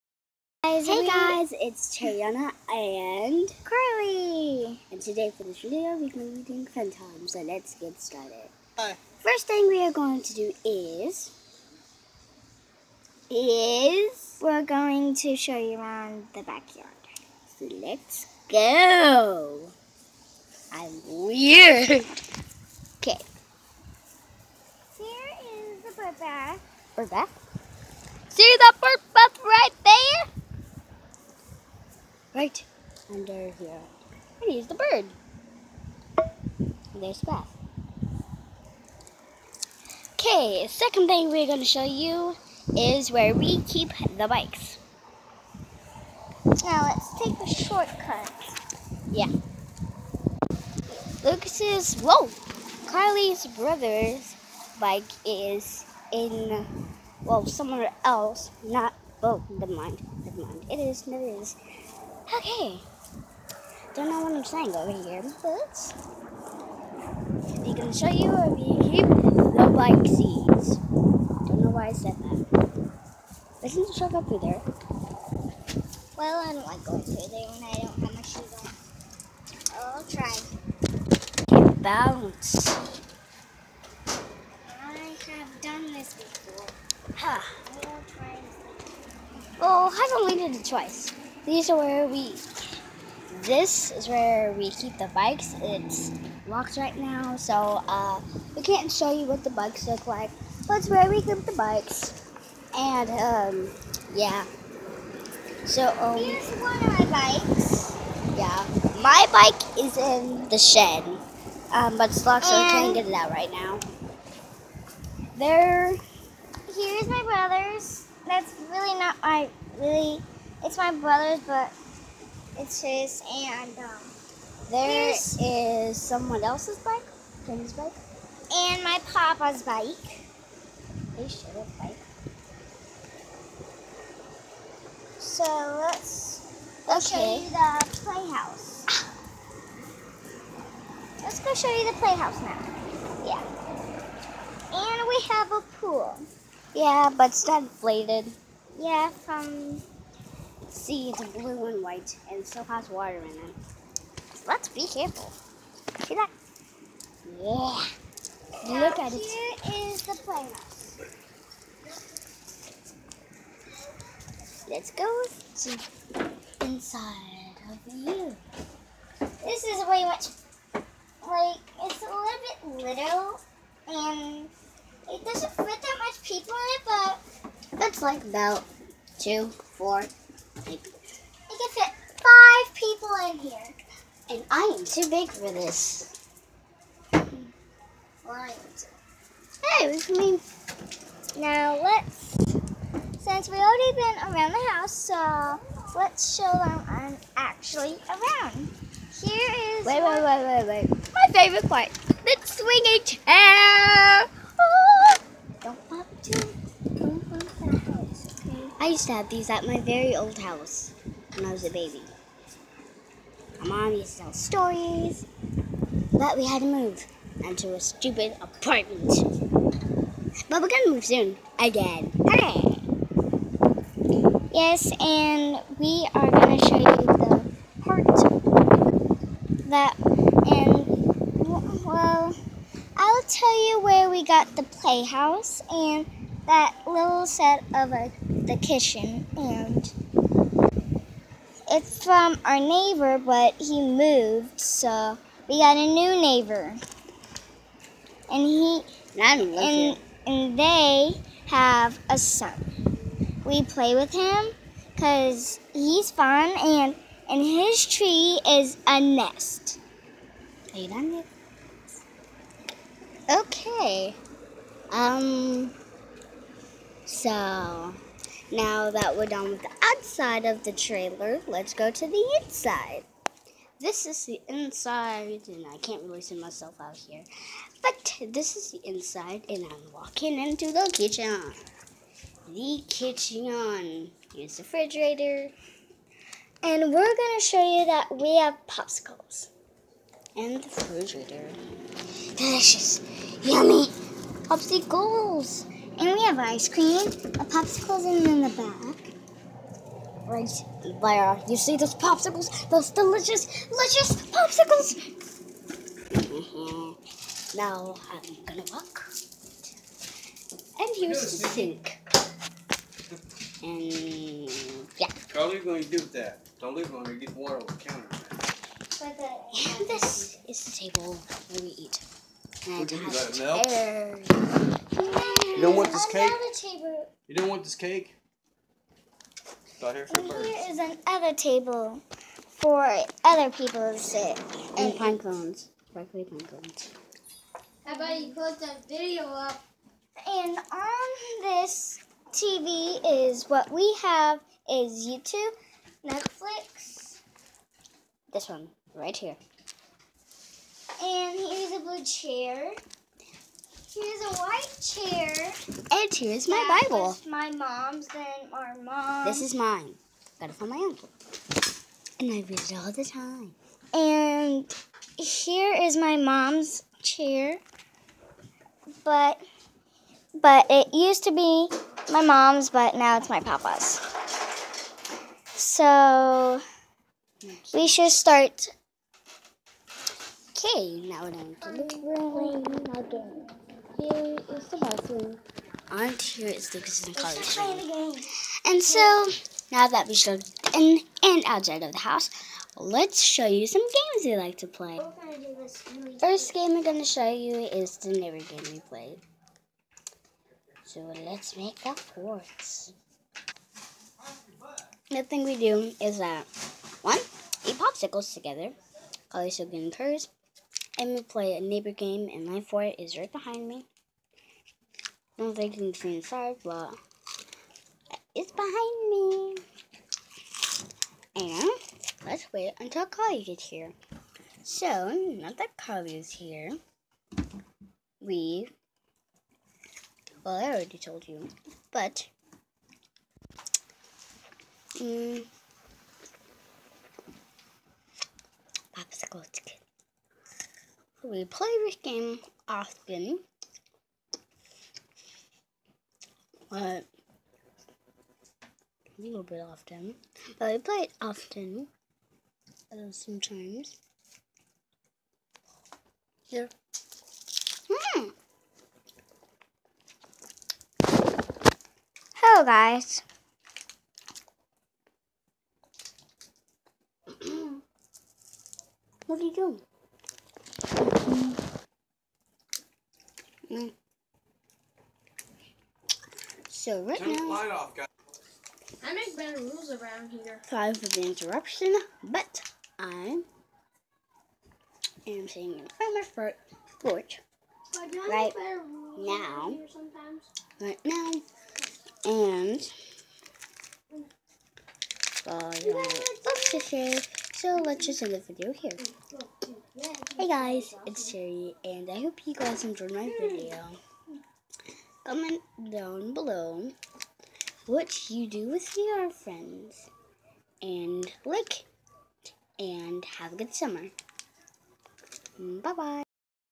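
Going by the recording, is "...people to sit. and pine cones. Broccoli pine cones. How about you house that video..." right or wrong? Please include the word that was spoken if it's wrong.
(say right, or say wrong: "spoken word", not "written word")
wrong: "close", not "house".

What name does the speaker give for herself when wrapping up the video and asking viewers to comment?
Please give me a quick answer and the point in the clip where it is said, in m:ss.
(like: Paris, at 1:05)
Cherry, at 8:21.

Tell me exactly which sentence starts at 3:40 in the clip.
But we're gonna move soon again.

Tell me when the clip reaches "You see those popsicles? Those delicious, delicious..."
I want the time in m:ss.
5:01.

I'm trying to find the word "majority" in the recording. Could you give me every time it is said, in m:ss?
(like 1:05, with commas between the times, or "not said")
not said.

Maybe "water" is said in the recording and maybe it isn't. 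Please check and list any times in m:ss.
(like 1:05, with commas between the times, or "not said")
2:32, 5:17.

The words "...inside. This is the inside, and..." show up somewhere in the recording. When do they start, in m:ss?
4:32.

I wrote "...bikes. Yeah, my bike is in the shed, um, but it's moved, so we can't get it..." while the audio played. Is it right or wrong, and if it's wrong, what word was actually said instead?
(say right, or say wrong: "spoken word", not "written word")
wrong: "locked", not "moved".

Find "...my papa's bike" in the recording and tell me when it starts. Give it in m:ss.
2:08.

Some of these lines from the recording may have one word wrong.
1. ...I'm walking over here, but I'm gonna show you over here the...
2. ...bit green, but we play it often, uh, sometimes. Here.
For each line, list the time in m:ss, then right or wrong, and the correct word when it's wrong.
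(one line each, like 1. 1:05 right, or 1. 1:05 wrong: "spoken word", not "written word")
1. 1:04 wrong: "saying", not "walking"
2. 7:29 wrong: "often", not "green".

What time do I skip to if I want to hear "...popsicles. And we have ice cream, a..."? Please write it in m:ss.
4:54.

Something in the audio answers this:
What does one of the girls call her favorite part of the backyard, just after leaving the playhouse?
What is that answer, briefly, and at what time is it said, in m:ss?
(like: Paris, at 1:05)
The swinging chair, at 3:21.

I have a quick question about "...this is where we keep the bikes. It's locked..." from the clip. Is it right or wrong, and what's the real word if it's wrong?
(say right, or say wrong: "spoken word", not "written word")
right.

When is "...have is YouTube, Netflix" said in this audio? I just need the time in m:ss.
5:44.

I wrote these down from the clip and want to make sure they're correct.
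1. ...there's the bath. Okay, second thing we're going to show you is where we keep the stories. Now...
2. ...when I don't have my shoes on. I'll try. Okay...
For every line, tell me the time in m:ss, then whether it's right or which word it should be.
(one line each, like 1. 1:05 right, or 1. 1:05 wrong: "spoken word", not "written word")
1. 0:37 wrong: "bikes", not "stories"
2. 1:17 right.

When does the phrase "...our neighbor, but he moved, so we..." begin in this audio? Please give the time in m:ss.
4:02.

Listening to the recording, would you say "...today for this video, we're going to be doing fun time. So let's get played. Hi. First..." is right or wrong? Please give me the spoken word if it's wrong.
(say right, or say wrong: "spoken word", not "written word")
wrong: "started", not "played".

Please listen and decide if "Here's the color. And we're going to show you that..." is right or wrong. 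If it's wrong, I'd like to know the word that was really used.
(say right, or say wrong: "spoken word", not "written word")
wrong: "refrigerator", not "color".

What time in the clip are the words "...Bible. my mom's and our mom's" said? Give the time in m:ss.
5:56.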